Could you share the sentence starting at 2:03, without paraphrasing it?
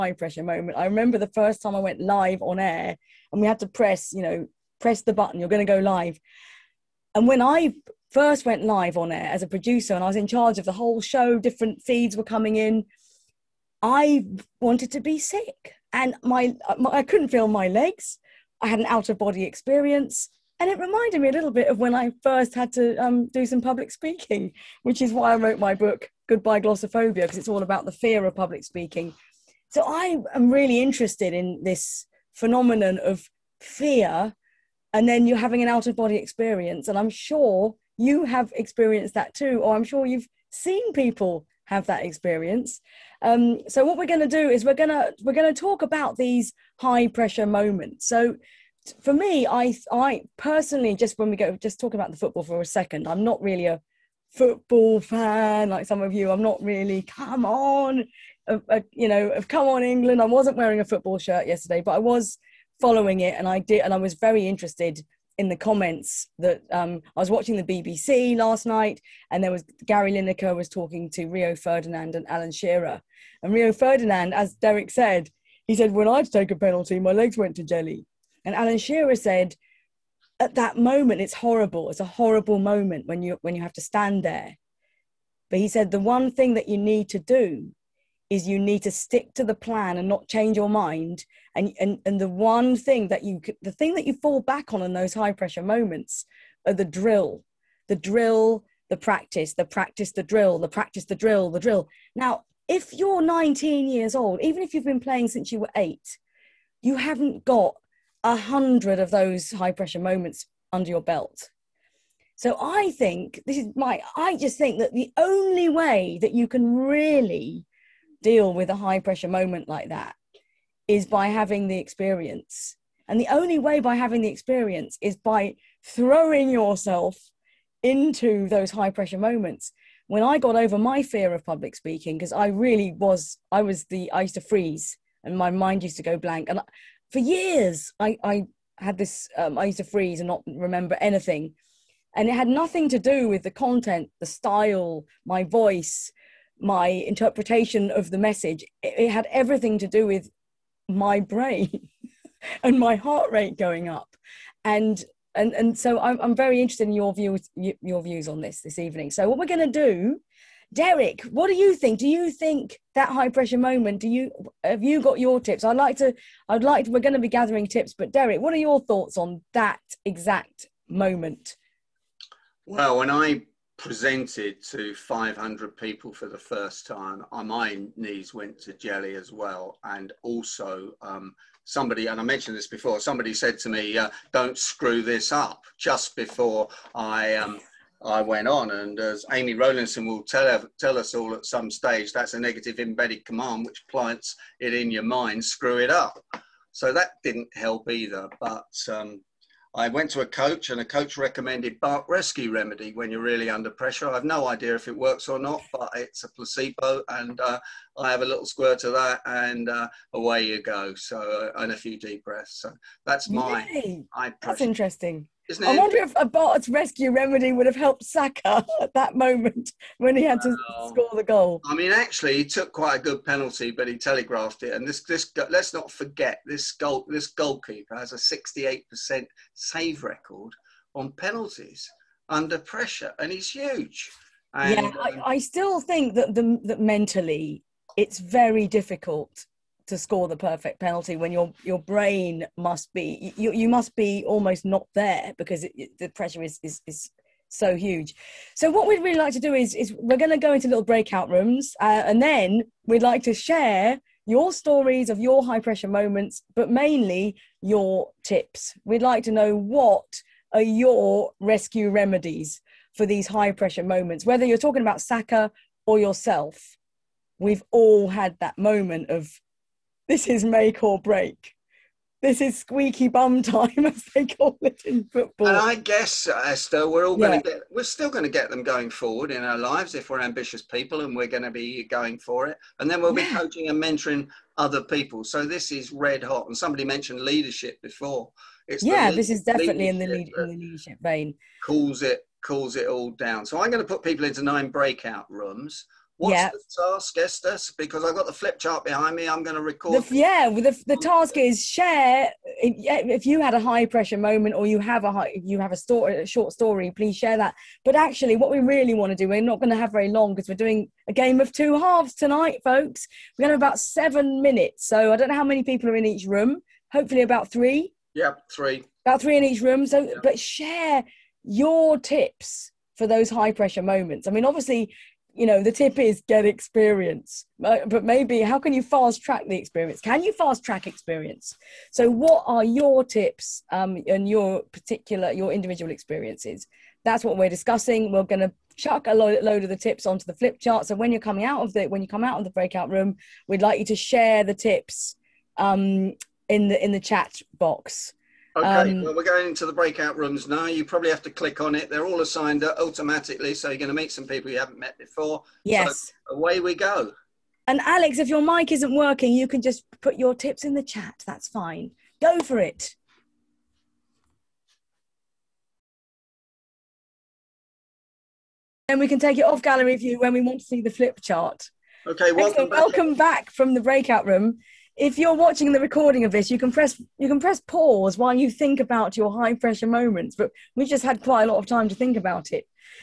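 And the only way by having the experience is by throwing yourself into those high pressure moments.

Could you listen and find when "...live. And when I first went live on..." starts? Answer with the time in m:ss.
0:05.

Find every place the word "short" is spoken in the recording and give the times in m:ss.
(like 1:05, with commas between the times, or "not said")
5:06.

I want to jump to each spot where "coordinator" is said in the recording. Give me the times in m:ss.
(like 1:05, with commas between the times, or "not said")
not said.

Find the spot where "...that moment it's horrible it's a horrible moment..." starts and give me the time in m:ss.
1:20.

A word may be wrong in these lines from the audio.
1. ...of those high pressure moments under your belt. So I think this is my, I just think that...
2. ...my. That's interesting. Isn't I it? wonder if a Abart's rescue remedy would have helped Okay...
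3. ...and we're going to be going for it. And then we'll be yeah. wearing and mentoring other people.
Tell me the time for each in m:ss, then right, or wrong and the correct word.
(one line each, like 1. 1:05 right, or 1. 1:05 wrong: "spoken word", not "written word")
1. 1:48 right
2. 3:33 wrong: "Saka", not "Okay"
3. 4:41 wrong: "coaching", not "wearing".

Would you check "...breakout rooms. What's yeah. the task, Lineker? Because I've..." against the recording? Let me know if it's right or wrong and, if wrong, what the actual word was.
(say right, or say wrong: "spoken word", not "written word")
wrong: "Esther", not "Lineker".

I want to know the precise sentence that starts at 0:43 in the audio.
Um, so what we're going to do is we're going to we're going to talk about these high pressure moments.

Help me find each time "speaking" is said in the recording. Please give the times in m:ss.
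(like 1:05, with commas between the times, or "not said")
0:23, 0:28, 2:11.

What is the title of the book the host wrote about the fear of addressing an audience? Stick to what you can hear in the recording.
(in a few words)
Goodbye Glossophobia.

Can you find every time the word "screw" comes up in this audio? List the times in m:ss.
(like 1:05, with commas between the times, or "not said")
3:04, 3:15.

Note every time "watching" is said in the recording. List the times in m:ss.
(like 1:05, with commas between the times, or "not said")
1:07, 6:15.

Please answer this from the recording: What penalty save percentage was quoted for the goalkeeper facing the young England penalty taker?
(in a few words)
68%.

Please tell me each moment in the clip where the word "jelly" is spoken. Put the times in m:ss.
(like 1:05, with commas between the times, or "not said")
1:17, 2:58.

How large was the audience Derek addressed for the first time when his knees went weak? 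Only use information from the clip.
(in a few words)
500 people.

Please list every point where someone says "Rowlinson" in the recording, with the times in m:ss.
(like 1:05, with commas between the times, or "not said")
3:09.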